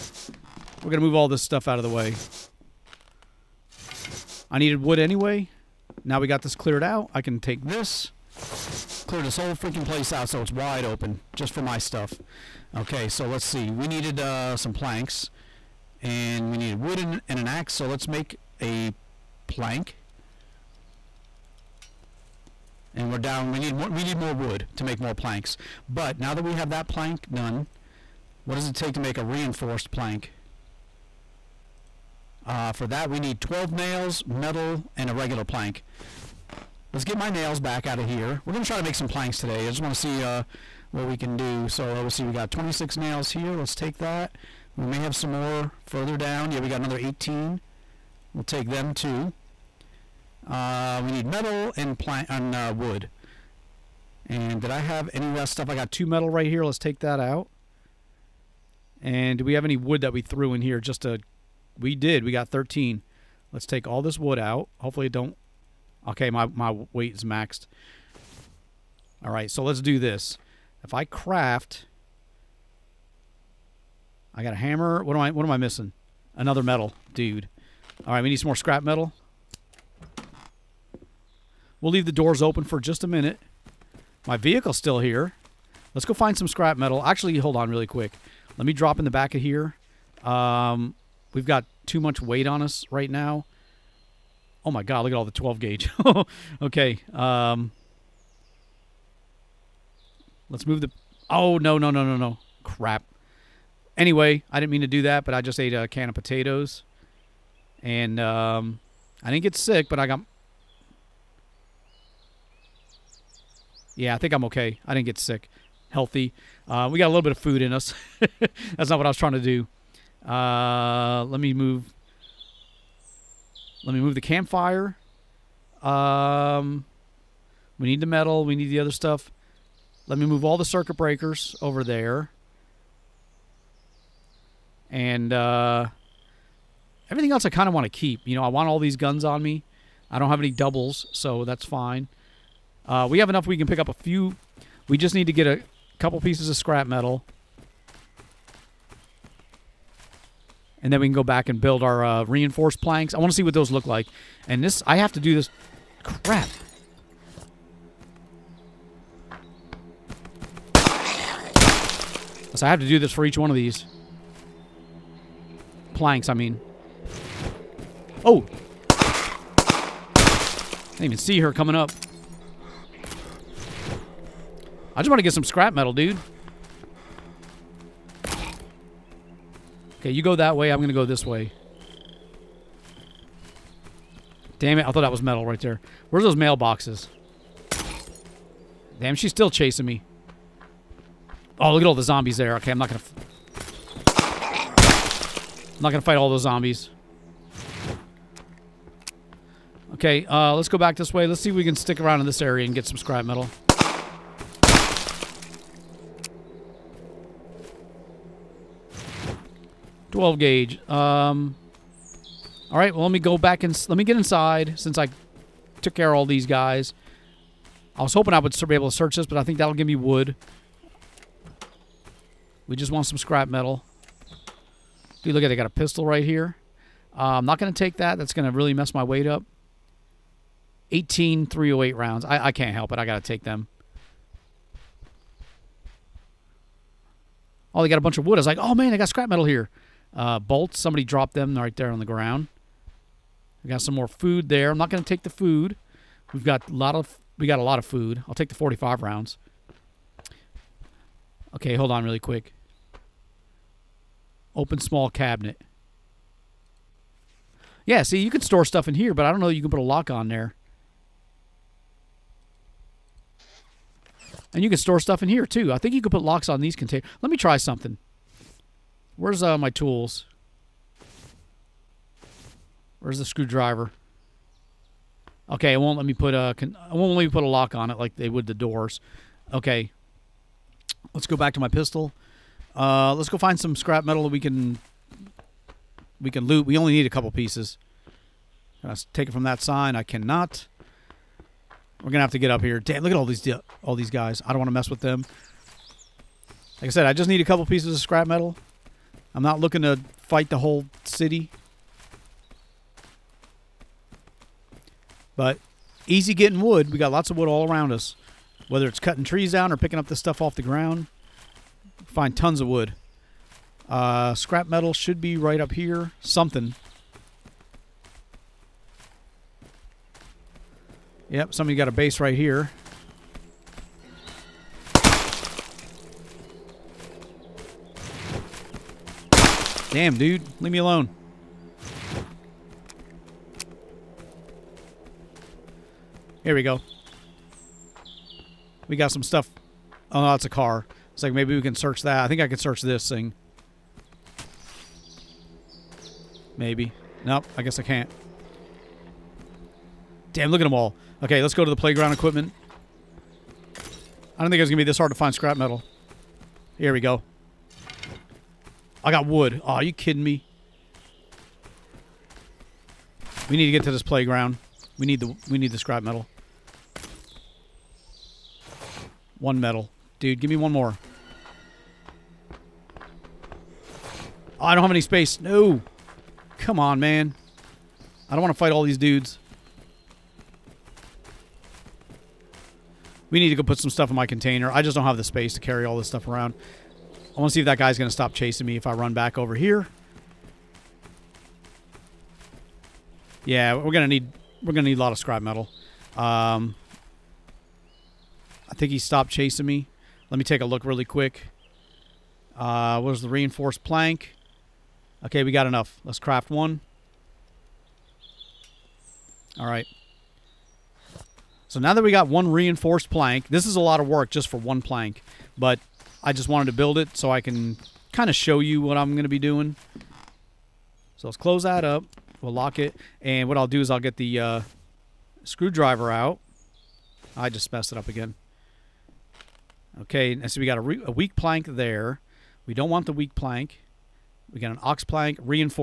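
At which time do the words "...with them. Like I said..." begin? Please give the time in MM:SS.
04:54.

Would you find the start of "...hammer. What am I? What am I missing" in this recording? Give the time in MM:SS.
01:14.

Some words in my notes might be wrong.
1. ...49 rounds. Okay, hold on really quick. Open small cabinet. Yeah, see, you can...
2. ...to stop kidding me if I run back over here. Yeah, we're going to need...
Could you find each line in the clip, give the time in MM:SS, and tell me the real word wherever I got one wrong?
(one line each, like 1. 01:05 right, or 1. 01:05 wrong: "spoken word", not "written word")
1. 04:08 wrong: "45", not "49"
2. 06:28 wrong: "chasing", not "kidding".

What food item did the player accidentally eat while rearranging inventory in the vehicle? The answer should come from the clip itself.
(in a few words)
can of potatoes.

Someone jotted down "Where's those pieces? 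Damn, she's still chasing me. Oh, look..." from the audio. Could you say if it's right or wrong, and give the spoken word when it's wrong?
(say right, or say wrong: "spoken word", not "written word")
wrong: "mailboxes", not "pieces".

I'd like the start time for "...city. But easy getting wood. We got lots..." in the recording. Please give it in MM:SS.
05:01.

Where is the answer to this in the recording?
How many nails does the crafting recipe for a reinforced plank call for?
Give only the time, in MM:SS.
00:33.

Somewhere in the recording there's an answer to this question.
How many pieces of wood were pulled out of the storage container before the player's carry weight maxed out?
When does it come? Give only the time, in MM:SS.
01:02.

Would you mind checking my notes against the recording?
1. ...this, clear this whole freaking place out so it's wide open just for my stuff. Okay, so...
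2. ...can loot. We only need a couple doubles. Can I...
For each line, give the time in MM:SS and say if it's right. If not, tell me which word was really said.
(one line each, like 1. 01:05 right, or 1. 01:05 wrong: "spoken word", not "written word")
1. 00:07 right
2. 04:46 wrong: "pieces", not "doubles".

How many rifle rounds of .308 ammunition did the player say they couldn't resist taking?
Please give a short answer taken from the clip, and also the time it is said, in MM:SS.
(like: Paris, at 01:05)
18, at 03:50.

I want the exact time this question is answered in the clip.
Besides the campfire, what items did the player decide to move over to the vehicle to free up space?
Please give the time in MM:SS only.
02:10.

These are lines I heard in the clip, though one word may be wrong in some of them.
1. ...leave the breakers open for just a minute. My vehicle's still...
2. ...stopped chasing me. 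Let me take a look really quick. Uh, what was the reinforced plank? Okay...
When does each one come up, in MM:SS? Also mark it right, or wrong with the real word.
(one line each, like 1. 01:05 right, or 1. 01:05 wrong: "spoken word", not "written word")
1. 01:21 wrong: "doors", not "breakers"
2. 06:38 right.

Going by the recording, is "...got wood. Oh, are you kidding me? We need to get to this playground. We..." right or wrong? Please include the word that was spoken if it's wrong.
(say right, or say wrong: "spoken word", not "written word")
right.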